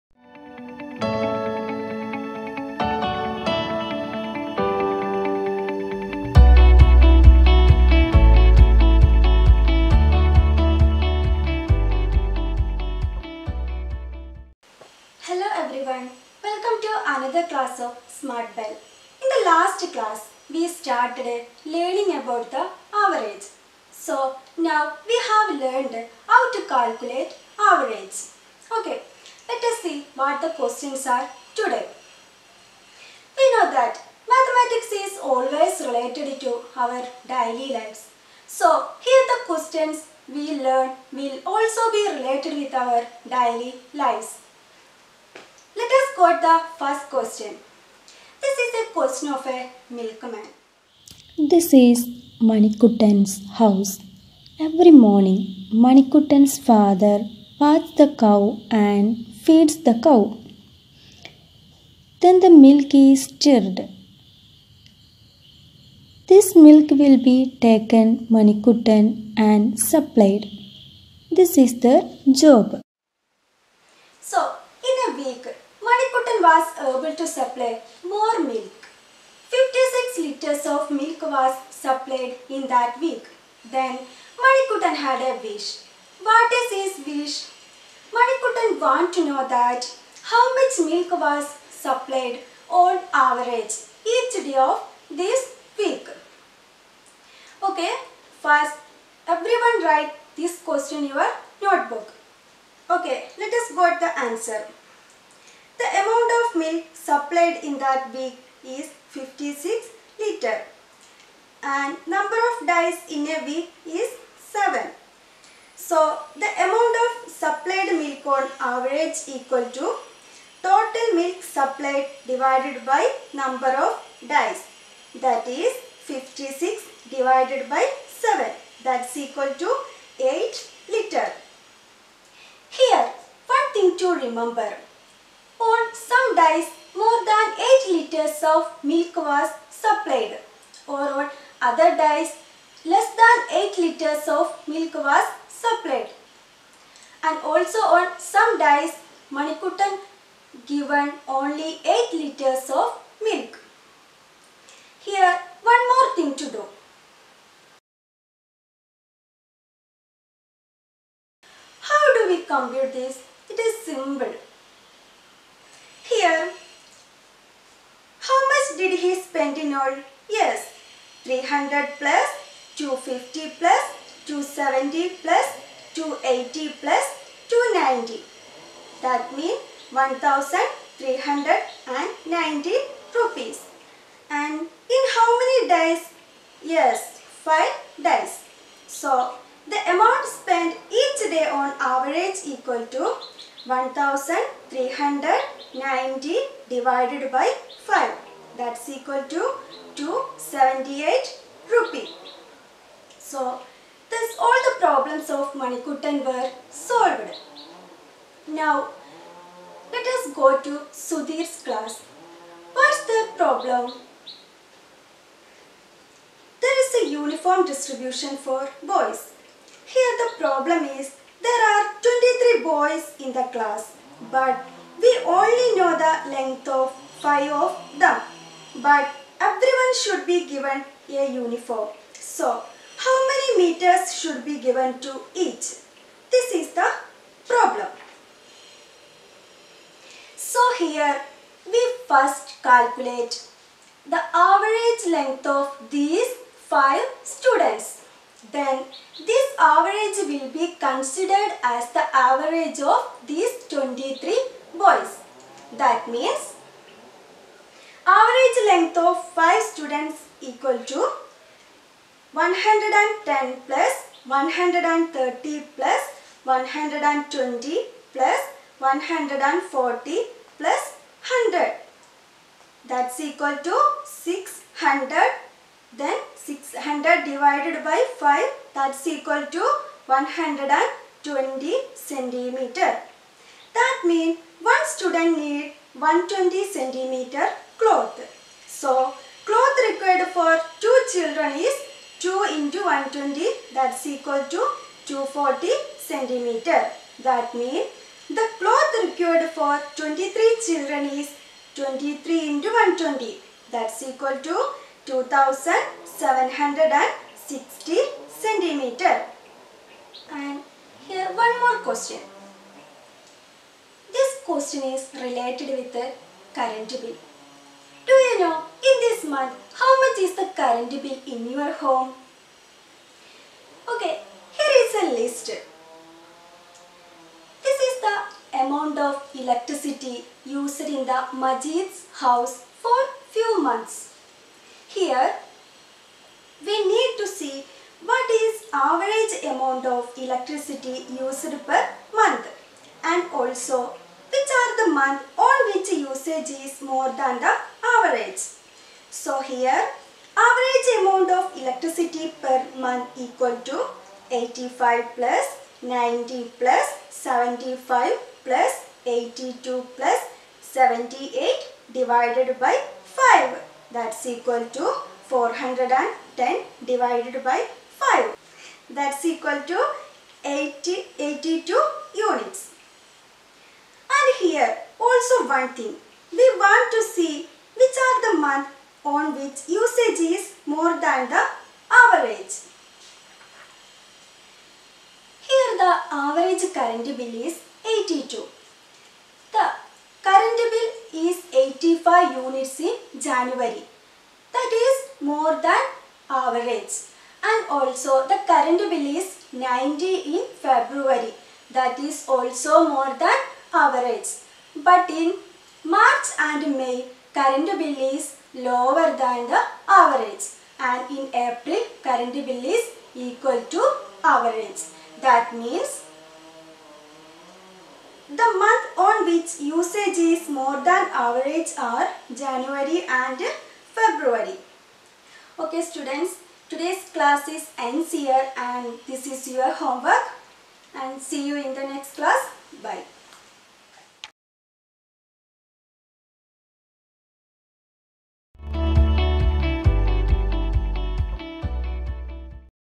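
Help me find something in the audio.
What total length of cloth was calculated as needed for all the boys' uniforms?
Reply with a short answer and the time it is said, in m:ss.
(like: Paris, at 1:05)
2760 centimetres, at 5:05.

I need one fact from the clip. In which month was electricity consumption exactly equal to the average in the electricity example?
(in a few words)
April.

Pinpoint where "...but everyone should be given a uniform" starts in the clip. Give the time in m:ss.
3:48.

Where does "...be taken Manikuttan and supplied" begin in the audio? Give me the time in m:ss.
1:07.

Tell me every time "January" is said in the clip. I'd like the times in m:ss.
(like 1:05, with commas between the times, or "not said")
6:33, 7:02.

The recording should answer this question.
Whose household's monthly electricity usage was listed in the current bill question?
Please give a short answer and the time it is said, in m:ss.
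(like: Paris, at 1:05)
Majid, at 5:31.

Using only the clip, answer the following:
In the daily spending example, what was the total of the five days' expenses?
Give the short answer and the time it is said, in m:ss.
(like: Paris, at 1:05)
1390 rupees, at 2:59.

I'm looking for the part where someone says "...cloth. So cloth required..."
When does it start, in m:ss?
4:47.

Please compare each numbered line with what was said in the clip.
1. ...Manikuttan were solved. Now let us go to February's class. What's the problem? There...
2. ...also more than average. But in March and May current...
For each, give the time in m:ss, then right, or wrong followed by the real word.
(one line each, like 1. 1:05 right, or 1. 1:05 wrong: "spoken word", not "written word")
1. 3:25 wrong: "Sudhir", not "February"
2. 6:42 right.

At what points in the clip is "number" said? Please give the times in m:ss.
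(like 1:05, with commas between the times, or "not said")
1:52, 2:03.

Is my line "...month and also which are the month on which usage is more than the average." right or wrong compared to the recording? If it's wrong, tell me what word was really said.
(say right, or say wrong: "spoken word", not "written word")
right.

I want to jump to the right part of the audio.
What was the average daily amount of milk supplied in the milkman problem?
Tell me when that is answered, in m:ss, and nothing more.
2:10.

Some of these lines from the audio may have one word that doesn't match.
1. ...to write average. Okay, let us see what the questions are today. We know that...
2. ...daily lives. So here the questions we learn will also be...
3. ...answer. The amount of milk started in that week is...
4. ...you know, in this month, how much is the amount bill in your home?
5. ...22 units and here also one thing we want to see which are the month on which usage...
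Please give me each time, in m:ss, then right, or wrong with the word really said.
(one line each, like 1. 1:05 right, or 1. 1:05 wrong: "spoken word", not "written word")
1. 0:26 wrong: "calculate", not "write"
2. 0:37 right
3. 1:44 wrong: "supplied", not "started"
4. 5:18 wrong: "current", not "amount"
5. 6:11 wrong: "82", not "22".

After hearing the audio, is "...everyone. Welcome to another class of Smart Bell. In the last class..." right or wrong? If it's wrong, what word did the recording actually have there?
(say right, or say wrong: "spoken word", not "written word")
right.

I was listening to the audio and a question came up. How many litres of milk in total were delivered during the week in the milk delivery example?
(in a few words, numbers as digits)
56 litres.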